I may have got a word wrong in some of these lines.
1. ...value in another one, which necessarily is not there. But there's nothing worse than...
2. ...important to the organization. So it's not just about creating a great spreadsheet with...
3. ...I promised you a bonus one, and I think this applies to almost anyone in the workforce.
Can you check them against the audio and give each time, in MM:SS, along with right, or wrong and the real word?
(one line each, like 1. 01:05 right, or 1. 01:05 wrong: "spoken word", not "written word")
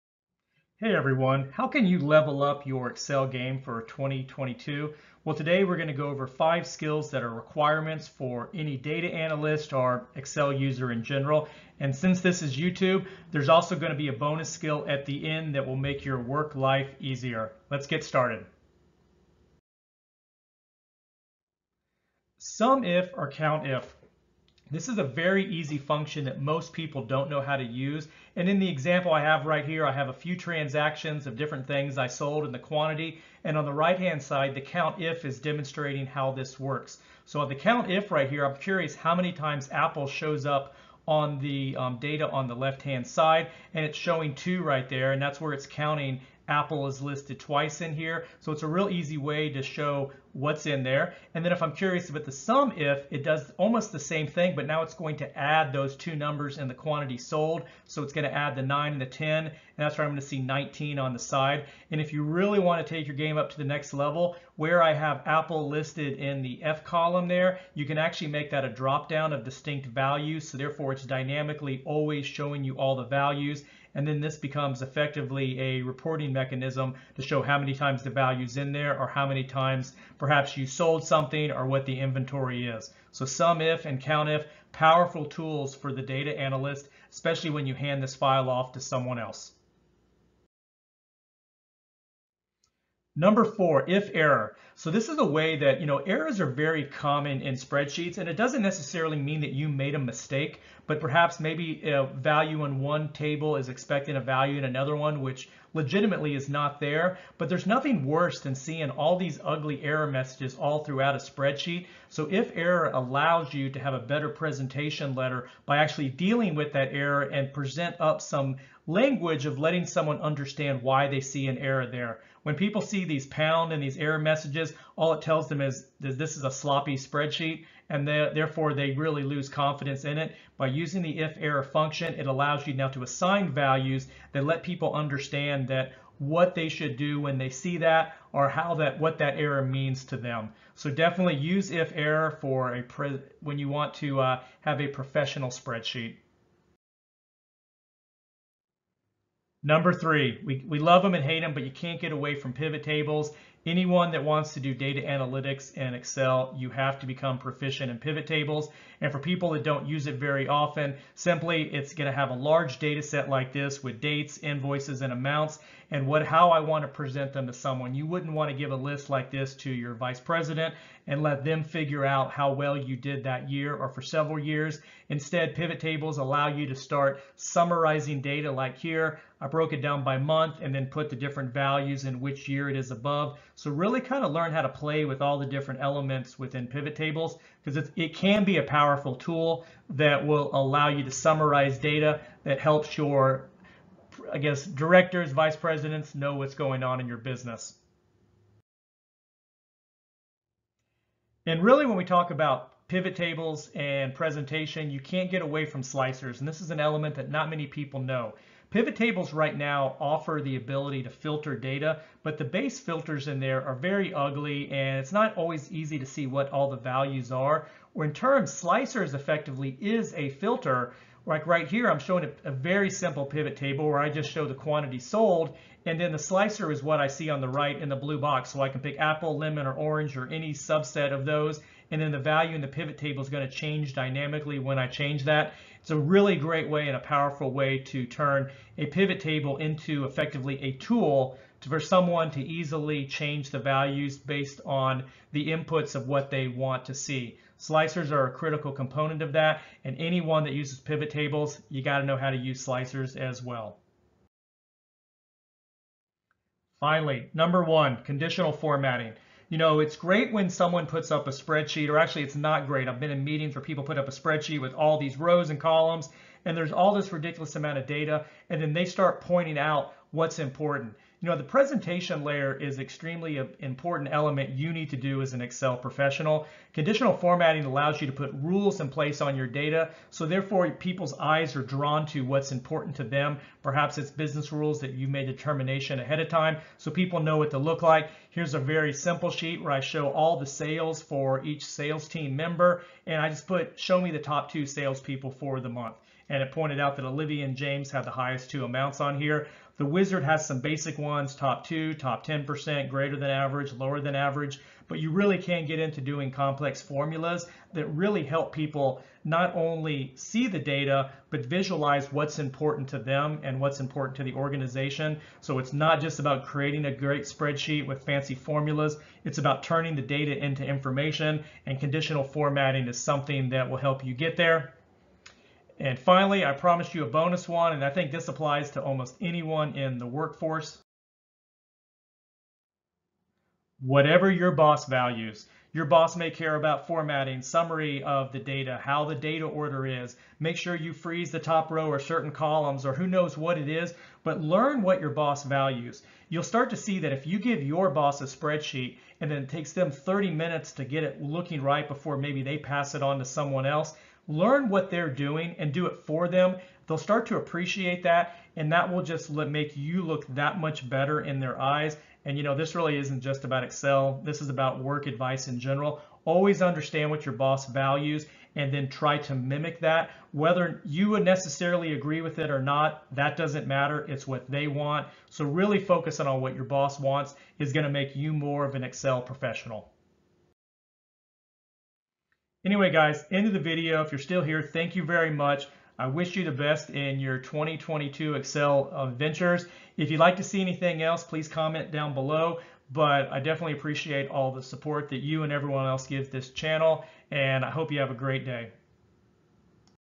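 1. 01:44 wrong: "legitimately", not "necessarily"
2. 05:13 right
3. 05:26 right.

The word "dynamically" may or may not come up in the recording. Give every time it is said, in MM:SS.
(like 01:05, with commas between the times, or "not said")
01:11, 03:53.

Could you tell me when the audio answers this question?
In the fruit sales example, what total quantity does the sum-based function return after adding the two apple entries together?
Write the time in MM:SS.
01:00.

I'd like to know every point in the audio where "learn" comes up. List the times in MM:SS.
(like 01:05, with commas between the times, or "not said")
03:04, 05:44, 05:54.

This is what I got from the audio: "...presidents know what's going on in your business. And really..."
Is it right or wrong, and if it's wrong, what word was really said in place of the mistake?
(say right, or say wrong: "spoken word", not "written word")
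right.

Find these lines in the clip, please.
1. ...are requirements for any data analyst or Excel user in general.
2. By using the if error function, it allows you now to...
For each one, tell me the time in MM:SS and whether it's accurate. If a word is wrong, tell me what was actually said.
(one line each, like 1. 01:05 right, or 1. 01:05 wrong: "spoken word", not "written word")
1. 00:07 right
2. 02:10 right.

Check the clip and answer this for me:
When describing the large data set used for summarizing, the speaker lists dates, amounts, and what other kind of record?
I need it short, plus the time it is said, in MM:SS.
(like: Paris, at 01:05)
invoices, at 02:44.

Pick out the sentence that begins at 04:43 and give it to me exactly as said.
Perhaps it's business rules that you made determination ahead of time, so people know what to look like.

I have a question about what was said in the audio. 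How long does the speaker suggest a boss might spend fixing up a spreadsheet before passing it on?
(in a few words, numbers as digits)
30 minutes.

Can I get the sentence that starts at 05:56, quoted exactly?
They'll start to appreciate that, and that will just make you look that much better in their eyes.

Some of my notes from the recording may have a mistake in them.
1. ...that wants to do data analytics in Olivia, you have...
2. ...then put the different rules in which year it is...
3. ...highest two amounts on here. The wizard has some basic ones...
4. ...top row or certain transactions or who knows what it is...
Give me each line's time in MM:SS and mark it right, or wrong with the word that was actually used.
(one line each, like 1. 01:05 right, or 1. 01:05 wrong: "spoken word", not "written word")
1. 02:34 wrong: "Excel", not "Olivia"
2. 03:00 wrong: "values", not "rules"
3. 04:58 right
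4. 05:41 wrong: "columns", not "transactions".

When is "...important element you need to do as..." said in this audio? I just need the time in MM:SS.
04:33.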